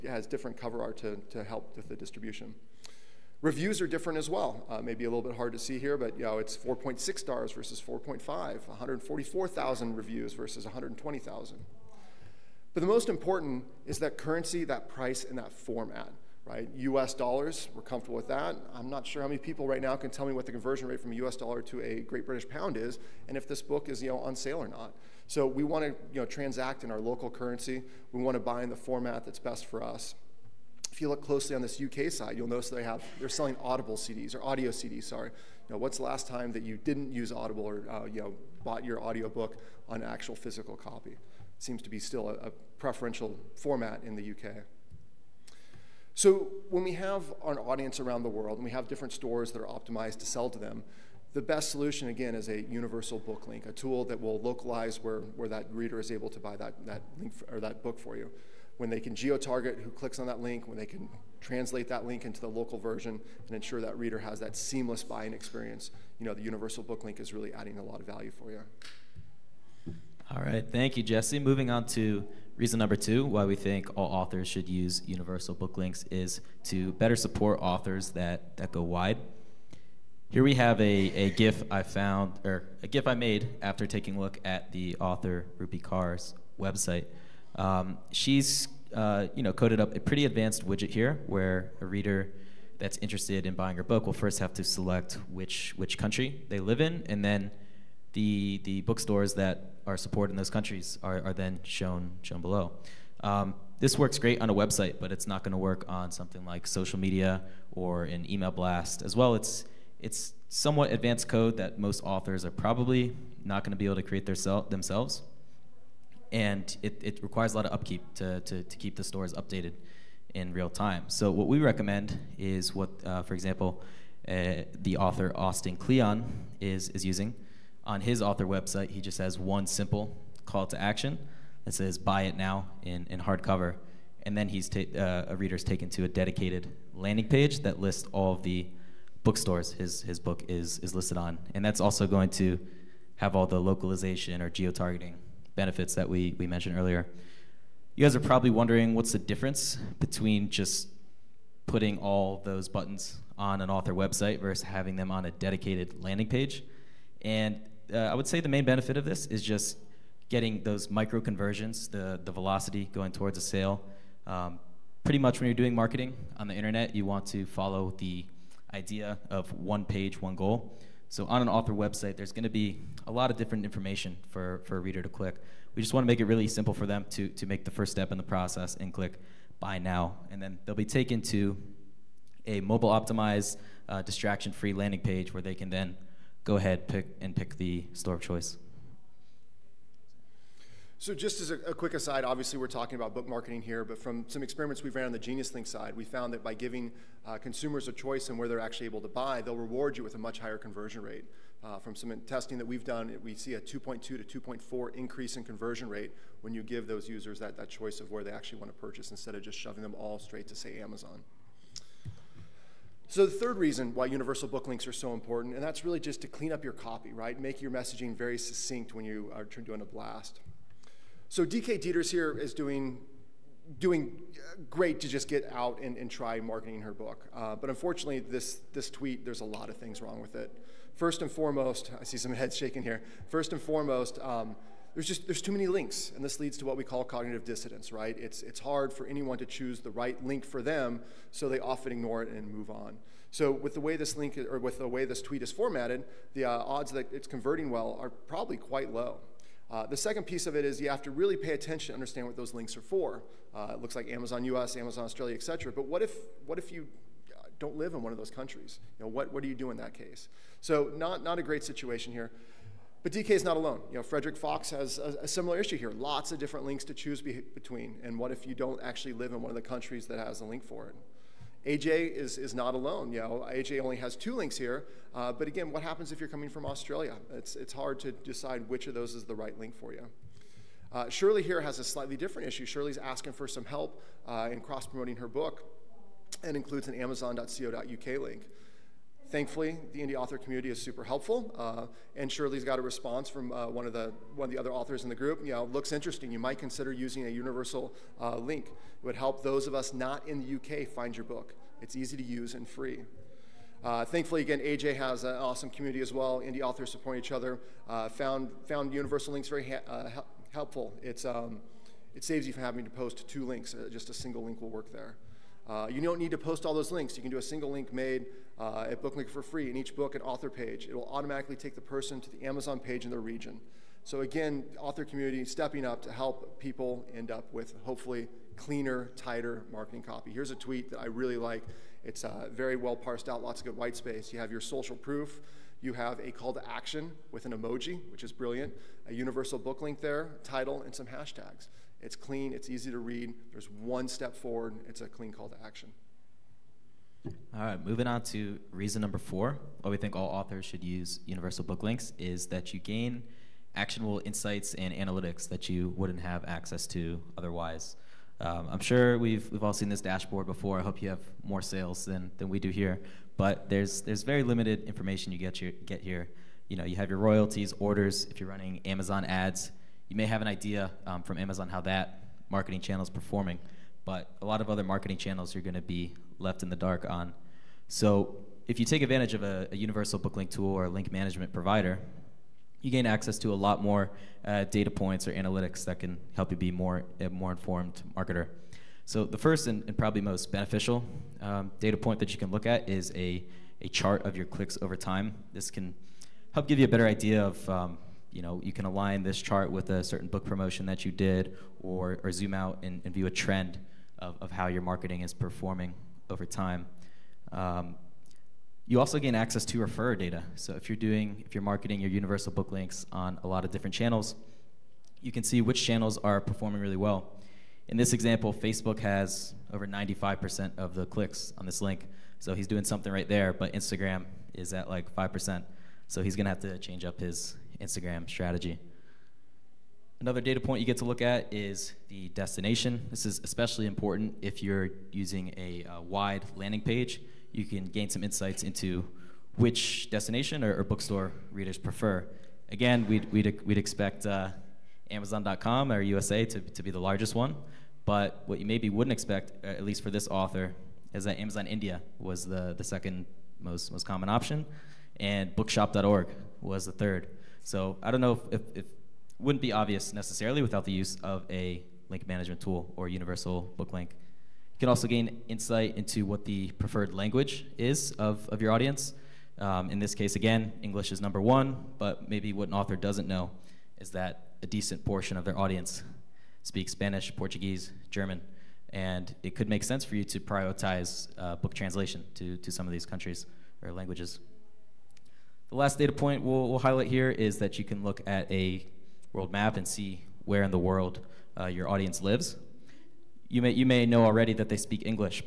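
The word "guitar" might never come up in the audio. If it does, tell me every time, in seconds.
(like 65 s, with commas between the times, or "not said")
not said.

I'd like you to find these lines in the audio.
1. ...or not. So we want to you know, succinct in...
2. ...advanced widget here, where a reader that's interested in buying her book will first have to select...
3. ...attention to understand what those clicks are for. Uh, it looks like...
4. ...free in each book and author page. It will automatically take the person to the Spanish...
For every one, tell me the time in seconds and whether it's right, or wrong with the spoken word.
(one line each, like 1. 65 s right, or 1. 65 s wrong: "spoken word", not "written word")
1. 24 s wrong: "transact", not "succinct"
2. 90 s right
3. 251 s wrong: "links", not "clicks"
4. 319 s wrong: "Amazon", not "Spanish".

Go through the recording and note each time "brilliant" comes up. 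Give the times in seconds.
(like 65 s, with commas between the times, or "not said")
338 s.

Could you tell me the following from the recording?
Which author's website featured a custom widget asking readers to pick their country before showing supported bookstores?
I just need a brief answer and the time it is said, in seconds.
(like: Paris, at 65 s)
Rupi Kaur, at 85 s.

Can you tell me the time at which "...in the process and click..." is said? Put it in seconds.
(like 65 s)
178 s.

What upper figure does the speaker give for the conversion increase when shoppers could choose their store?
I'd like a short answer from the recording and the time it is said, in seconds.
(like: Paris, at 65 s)
2.4, at 204 s.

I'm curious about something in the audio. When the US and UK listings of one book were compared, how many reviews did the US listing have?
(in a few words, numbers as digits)
144,000.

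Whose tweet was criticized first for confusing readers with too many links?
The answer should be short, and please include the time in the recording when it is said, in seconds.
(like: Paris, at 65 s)
DK Dieters, at 221 s.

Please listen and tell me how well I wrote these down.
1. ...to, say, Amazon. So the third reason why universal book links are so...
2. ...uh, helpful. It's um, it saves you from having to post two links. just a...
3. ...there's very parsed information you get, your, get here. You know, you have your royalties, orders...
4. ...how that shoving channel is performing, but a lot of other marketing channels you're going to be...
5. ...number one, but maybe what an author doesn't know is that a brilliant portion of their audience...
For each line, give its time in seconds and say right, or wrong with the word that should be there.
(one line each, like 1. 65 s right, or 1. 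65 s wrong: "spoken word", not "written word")
1. 210 s right
2. 309 s right
3. 364 s wrong: "limited", not "parsed"
4. 371 s wrong: "marketing", not "shoving"
5. 471 s wrong: "decent", not "brilliant".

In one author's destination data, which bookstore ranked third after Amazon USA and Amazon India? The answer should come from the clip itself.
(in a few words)
bookshop.org.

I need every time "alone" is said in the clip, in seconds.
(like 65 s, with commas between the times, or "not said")
263 s, 272 s.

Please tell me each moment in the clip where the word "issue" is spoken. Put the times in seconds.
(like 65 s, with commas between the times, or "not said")
265 s, 282 s.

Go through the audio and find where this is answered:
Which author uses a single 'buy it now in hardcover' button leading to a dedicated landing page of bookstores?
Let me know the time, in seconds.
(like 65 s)
125 s.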